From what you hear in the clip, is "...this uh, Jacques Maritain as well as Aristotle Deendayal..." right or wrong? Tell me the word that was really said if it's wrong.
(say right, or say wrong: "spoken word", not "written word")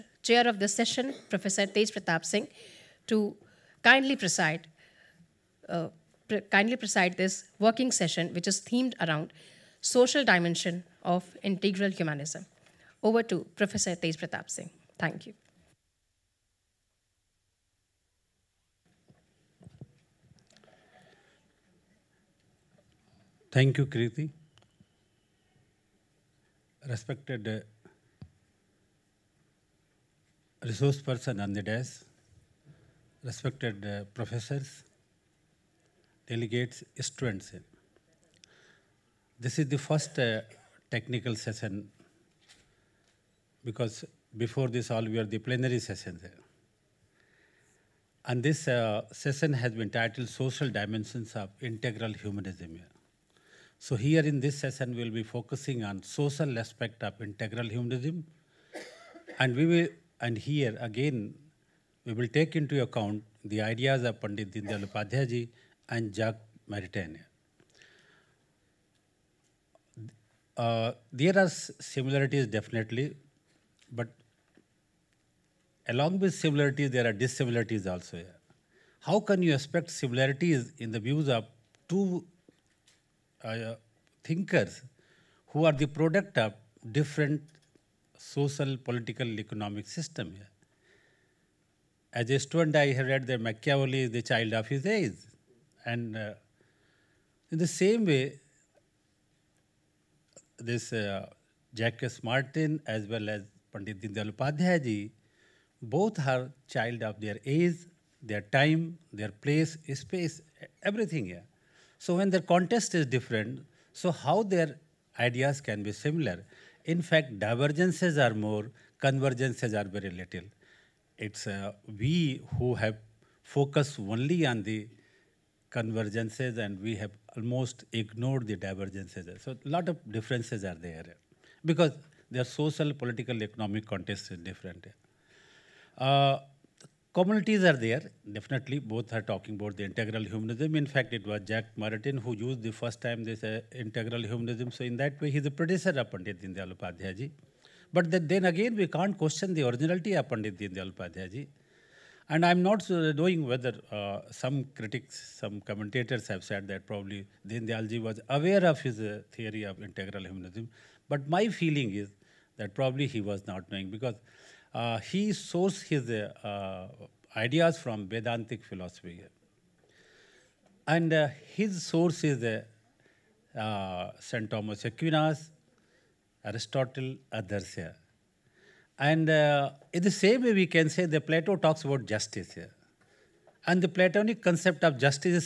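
wrong: "Pandit", not "Aristotle".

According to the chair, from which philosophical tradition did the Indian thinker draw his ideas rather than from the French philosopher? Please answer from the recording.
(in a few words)
Vedantic philosophy.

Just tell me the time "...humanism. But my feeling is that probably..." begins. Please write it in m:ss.
2:40.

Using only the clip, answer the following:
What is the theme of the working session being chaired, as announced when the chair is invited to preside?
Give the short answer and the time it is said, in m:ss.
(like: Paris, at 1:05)
Social dimension of integral humanism, at 0:09.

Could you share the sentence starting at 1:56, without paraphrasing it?
In fact, divergences are more, convergences are very little.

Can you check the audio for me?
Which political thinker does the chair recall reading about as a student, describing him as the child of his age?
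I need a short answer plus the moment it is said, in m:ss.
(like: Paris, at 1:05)
Machiavelli, at 1:33.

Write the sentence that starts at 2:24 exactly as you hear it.
So in that way, he's a predecessor of Pandit Deendayal Upadhyay ji.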